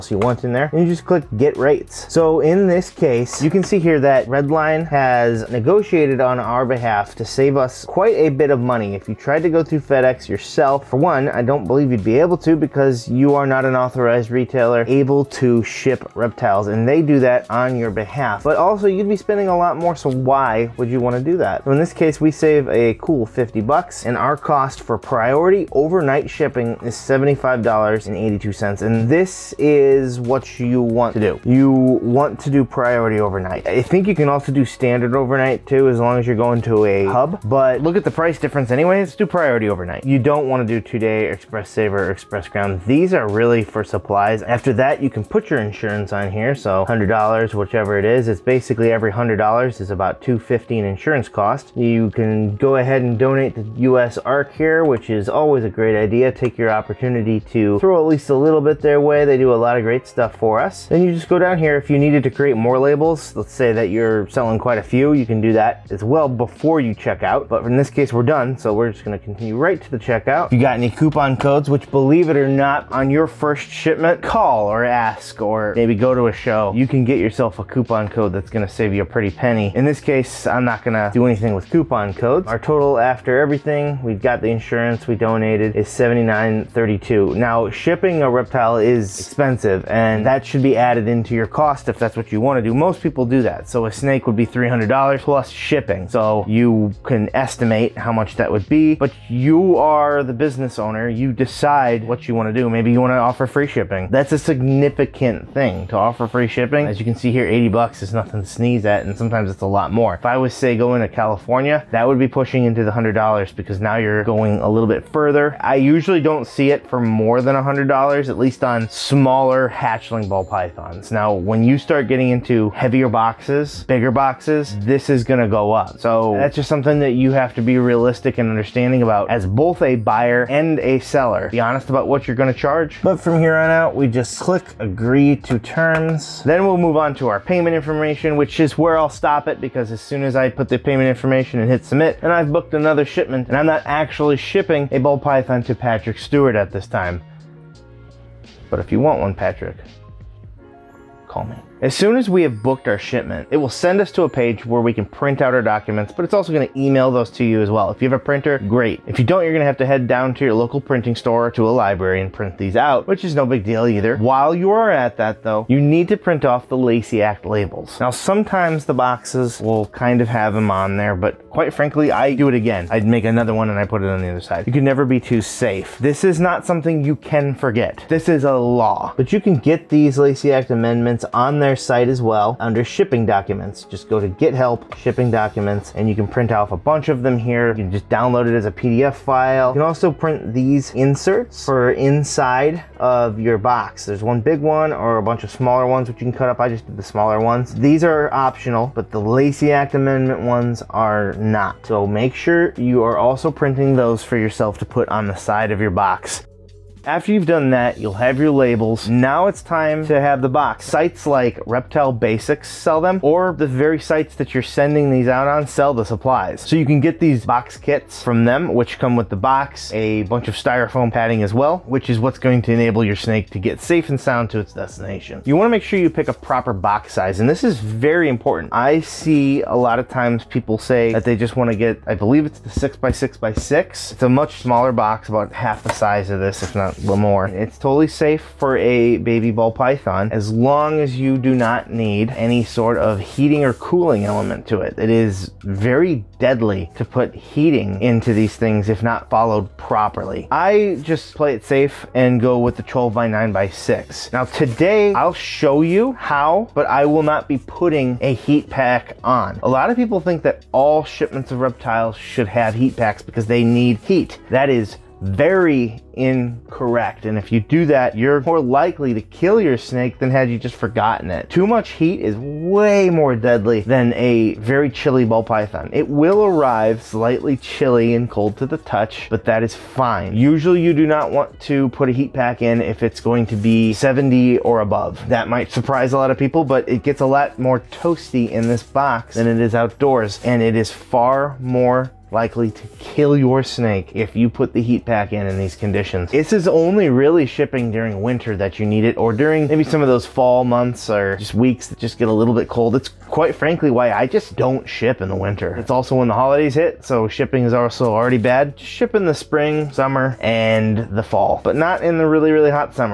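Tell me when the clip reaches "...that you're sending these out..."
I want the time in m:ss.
3:34.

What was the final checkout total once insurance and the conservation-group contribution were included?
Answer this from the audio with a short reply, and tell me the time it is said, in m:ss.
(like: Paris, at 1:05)
$79.32, at 1:25.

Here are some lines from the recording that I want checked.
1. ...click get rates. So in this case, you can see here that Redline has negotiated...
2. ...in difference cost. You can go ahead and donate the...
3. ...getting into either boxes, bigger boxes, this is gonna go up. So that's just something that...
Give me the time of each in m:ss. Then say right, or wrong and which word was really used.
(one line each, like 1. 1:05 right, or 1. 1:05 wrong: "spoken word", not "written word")
1. 0:01 right
2. 0:50 wrong: "insurance", not "difference"
3. 2:02 wrong: "heavier", not "either".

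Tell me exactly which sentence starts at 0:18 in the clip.
But also you'd be spending a lot more, so why would you wanna do that?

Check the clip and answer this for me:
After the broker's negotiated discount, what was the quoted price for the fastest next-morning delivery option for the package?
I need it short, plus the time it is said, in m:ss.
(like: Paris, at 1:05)
$75.82, at 0:26.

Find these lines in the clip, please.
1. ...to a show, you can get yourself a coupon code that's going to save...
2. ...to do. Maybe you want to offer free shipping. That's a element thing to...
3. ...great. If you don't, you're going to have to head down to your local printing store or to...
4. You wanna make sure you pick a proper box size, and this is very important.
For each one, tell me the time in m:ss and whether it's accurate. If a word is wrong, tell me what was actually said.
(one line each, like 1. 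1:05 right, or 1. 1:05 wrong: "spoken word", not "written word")
1. 1:16 right
2. 1:42 wrong: "significant", not "element"
3. 2:38 right
4. 3:45 right.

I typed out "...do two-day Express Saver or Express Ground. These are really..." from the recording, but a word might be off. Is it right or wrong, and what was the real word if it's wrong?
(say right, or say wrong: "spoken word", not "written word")
right.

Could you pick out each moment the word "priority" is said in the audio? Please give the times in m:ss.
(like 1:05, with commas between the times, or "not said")
0:25, 0:32, 0:39.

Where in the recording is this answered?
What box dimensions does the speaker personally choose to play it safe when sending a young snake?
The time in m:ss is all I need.
4:12.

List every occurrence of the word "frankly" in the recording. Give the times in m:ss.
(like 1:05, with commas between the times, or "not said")
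2:51, 5:03.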